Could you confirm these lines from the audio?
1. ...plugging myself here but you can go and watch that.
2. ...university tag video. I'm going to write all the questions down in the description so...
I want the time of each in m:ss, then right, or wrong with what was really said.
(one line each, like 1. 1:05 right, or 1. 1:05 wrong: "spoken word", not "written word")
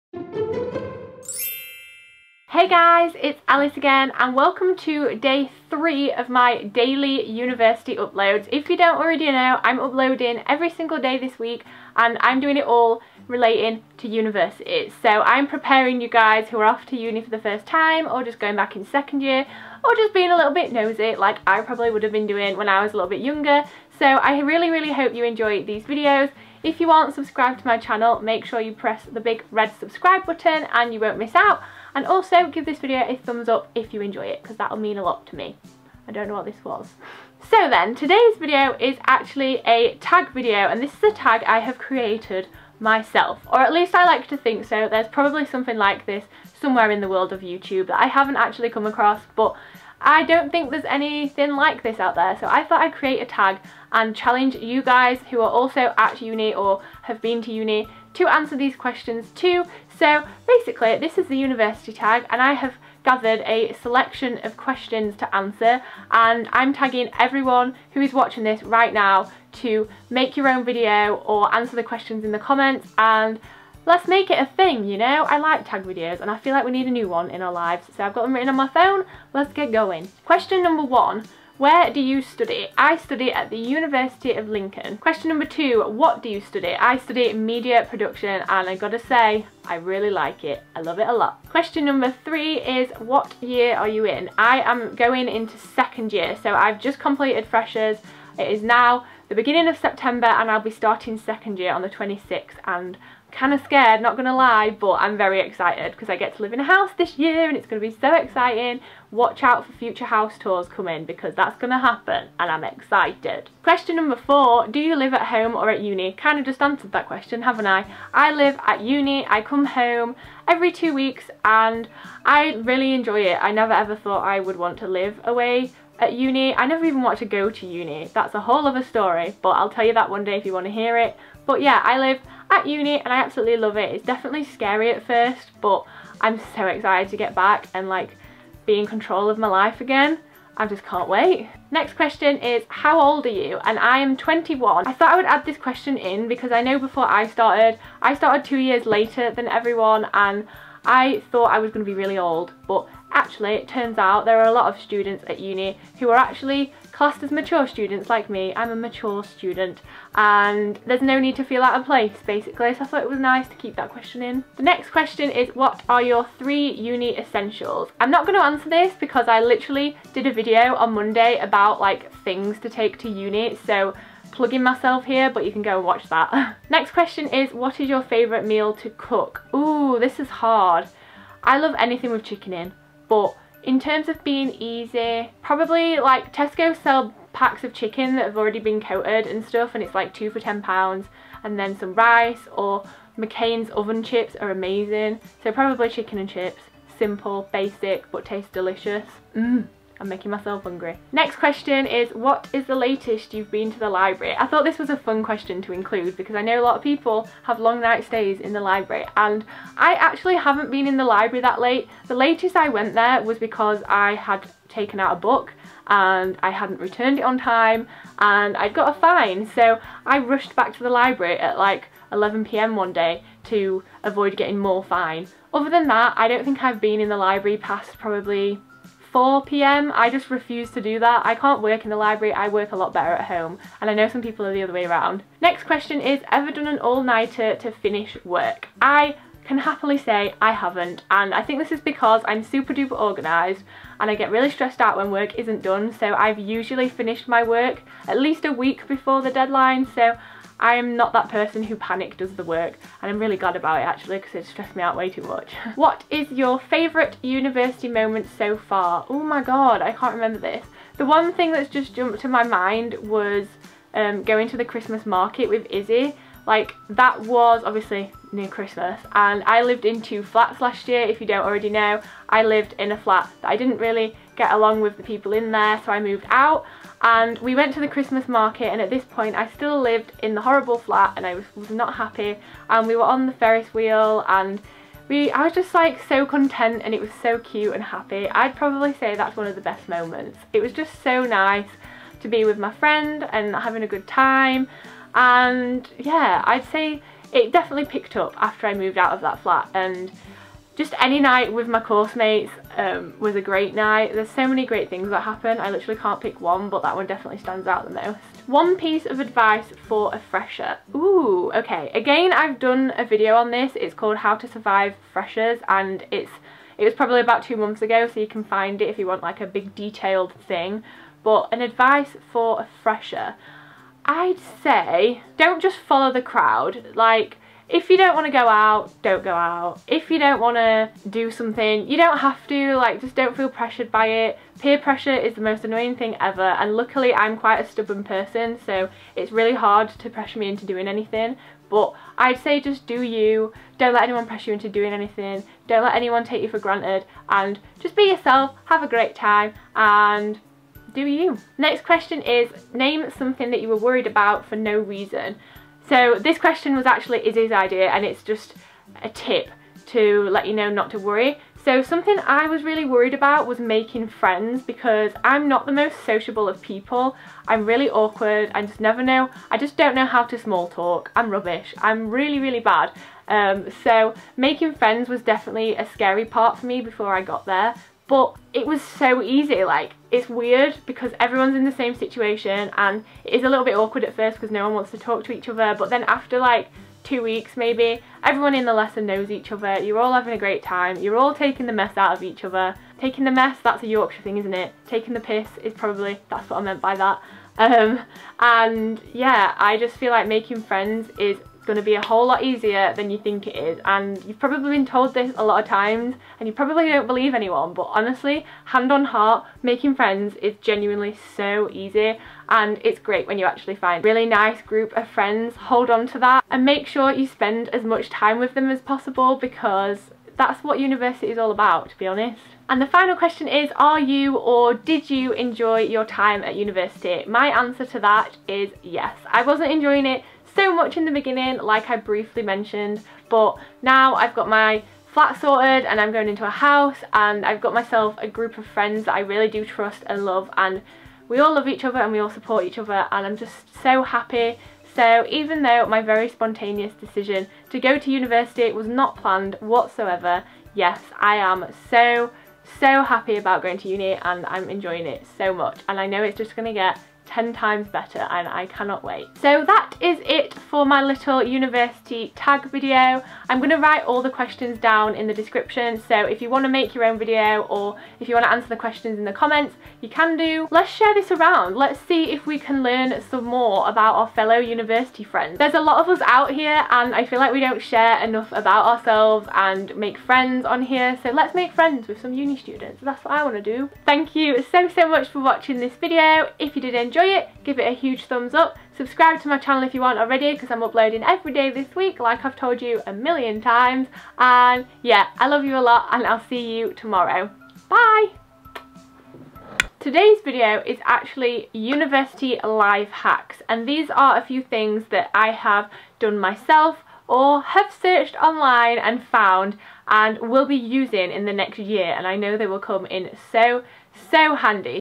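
1. 2:54 right
2. 7:41 right.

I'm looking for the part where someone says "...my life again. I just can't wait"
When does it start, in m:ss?
2:19.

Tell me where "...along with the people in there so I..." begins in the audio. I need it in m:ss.
4:34.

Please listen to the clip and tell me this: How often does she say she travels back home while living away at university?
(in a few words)
Every two weeks.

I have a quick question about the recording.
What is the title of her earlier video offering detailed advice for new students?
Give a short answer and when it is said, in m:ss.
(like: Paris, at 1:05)
How to Survive Freshers, at 5:14.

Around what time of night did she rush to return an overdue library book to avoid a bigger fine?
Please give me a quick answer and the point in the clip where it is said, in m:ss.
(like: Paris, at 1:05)
11pm, at 3:42.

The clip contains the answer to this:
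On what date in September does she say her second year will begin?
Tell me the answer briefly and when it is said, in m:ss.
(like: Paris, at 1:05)
26th, at 1:41.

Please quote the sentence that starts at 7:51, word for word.
Let's see if we can learn some more about our fellow university friends.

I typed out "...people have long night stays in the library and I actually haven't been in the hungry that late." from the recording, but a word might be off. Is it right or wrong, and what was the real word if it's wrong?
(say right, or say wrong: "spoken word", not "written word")
wrong: "library", not "hungry".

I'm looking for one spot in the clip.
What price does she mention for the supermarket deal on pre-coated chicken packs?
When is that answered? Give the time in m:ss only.
3:10.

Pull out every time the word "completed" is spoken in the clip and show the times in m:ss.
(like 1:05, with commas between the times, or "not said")
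1:36.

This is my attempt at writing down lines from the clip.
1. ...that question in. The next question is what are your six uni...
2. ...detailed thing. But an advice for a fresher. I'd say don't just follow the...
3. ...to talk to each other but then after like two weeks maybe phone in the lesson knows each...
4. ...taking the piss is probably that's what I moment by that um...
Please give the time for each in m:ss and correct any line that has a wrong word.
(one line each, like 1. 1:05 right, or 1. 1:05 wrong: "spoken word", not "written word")
1. 2:43 wrong: "three", not "six"
2. 5:19 right
3. 6:24 wrong: "everyone", not "phone"
4. 6:34 wrong: "meant", not "moment".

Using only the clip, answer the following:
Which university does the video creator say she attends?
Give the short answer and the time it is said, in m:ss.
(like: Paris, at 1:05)
University of Lincoln, at 1:23.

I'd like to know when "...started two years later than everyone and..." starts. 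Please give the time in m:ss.
2:28.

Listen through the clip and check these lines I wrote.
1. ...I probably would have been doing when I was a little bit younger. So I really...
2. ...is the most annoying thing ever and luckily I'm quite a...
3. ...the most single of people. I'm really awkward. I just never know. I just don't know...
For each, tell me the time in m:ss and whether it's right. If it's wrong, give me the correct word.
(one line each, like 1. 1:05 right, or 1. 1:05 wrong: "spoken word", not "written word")
1. 0:21 right
2. 5:35 right
3. 6:05 wrong: "sociable", not "single".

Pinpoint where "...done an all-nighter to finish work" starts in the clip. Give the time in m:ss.
3:56.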